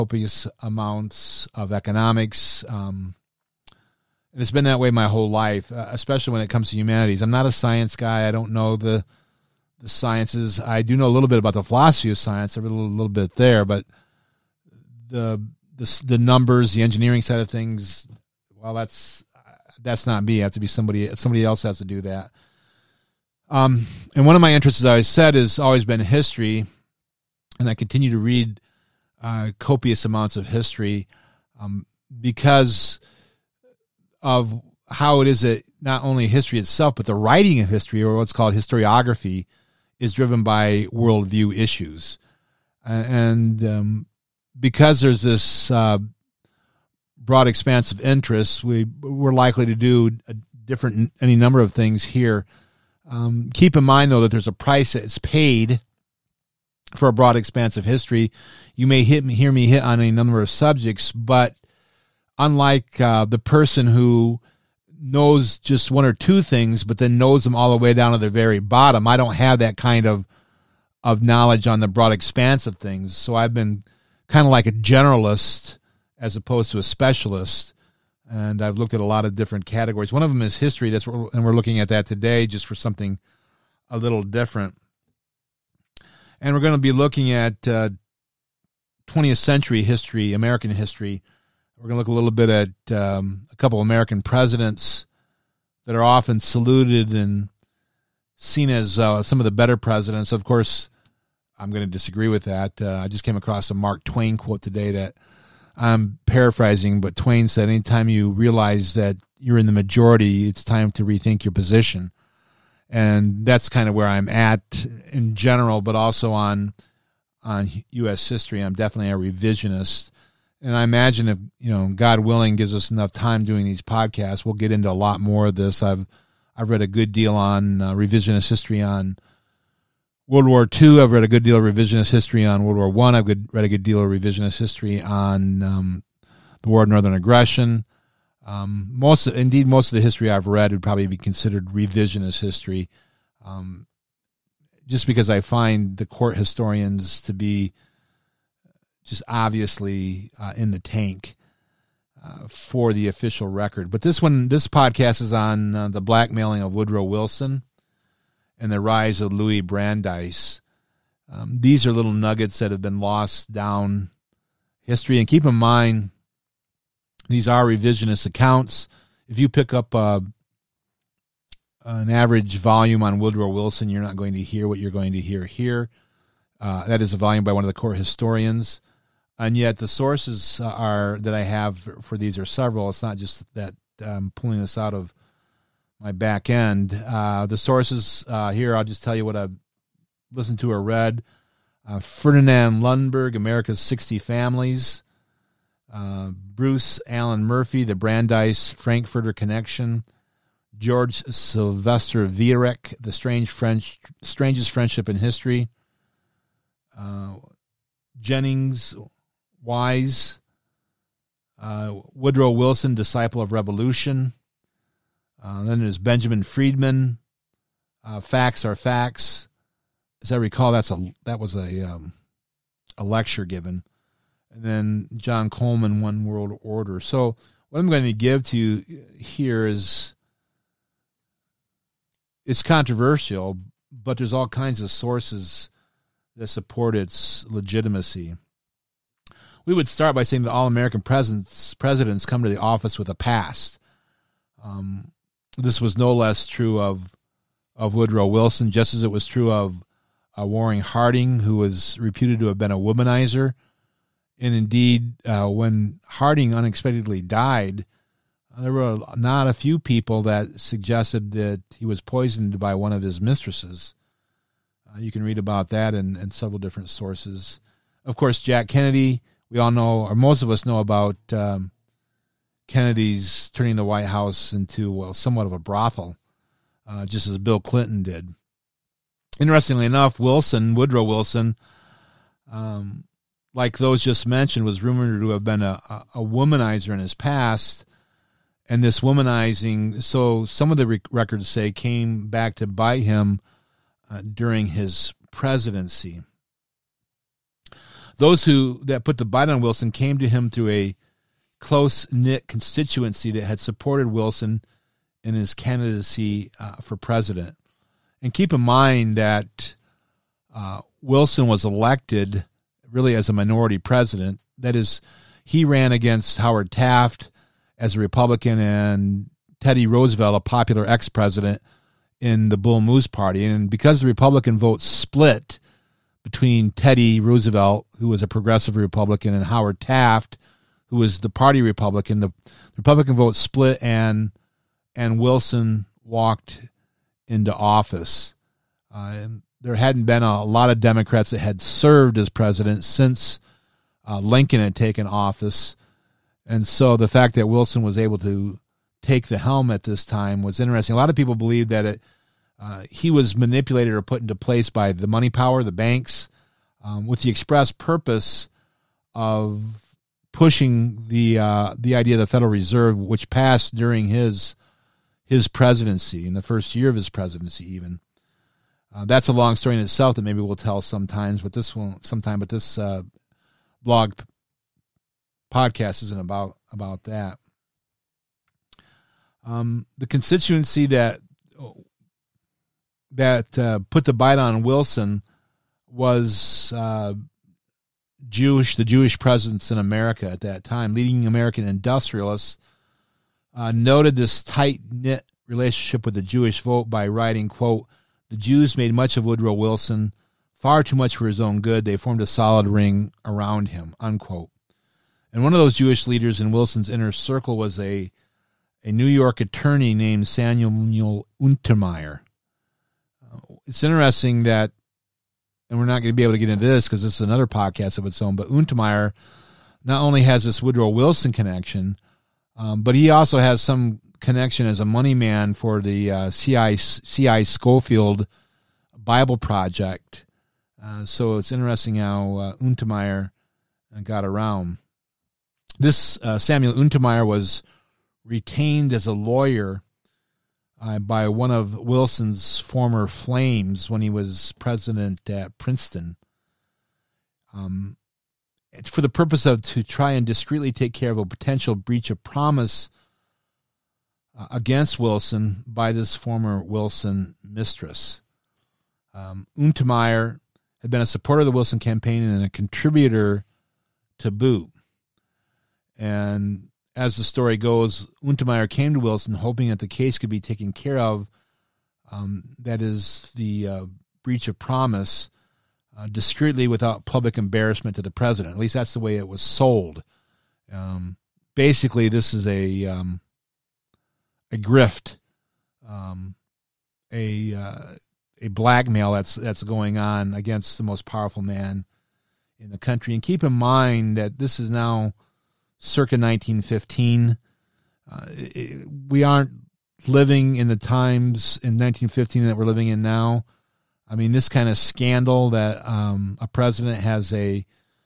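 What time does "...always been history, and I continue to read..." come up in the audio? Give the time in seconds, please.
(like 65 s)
25 s.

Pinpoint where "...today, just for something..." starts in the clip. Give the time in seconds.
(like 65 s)
82 s.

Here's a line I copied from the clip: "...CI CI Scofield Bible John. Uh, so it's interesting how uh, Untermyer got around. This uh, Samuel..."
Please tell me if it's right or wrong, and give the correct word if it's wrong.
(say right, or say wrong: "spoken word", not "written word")
wrong: "Project", not "John".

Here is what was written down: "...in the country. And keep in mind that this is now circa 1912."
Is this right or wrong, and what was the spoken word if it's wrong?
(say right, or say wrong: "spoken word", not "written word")
wrong: "1915", not "1912".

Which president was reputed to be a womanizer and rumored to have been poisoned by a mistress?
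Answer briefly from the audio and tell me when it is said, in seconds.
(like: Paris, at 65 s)
Warren Harding, at 250 s.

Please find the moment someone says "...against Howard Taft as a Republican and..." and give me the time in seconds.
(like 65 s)
315 s.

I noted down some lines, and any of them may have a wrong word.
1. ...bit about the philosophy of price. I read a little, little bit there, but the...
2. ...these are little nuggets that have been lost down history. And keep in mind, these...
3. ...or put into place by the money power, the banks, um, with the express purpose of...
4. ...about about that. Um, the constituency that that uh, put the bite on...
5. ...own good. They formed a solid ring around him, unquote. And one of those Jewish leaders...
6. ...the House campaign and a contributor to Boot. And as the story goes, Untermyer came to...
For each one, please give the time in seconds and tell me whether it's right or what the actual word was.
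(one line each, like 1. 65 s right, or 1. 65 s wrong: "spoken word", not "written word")
1. 11 s wrong: "science", not "price"
2. 161 s right
3. 353 s right
4. 376 s right
5. 401 s right
6. 461 s wrong: "Wilson", not "House".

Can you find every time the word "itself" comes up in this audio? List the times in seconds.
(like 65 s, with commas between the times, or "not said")
36 s, 369 s.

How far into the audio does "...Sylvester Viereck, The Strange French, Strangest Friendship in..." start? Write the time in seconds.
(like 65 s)
201 s.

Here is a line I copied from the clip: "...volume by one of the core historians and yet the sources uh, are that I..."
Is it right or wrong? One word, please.
right.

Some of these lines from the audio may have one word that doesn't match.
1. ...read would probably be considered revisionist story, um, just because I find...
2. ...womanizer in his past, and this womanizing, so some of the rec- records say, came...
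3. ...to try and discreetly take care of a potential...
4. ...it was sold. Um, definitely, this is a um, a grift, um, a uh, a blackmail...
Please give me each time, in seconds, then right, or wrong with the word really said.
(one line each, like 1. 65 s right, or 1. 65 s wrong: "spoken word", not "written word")
1. 140 s wrong: "history", not "story"
2. 286 s right
3. 449 s right
4. 479 s wrong: "basically", not "definitely".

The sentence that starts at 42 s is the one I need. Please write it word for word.
And um, because there's this uh, broad expanse of interests, we, we're likely to do different any number of things here.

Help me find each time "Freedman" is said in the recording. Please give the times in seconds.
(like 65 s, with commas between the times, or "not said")
216 s.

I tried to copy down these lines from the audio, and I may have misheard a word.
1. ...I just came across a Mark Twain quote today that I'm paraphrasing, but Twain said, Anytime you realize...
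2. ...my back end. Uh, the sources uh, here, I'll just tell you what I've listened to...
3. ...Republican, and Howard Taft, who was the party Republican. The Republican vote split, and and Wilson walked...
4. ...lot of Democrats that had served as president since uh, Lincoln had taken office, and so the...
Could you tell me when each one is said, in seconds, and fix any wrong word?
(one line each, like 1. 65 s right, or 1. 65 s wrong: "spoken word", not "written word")
1. 103 s right
2. 186 s right
3. 328 s right
4. 340 s right.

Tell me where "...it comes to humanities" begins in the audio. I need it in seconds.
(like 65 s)
6 s.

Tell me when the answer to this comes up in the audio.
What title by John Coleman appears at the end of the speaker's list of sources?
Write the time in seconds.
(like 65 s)
226 s.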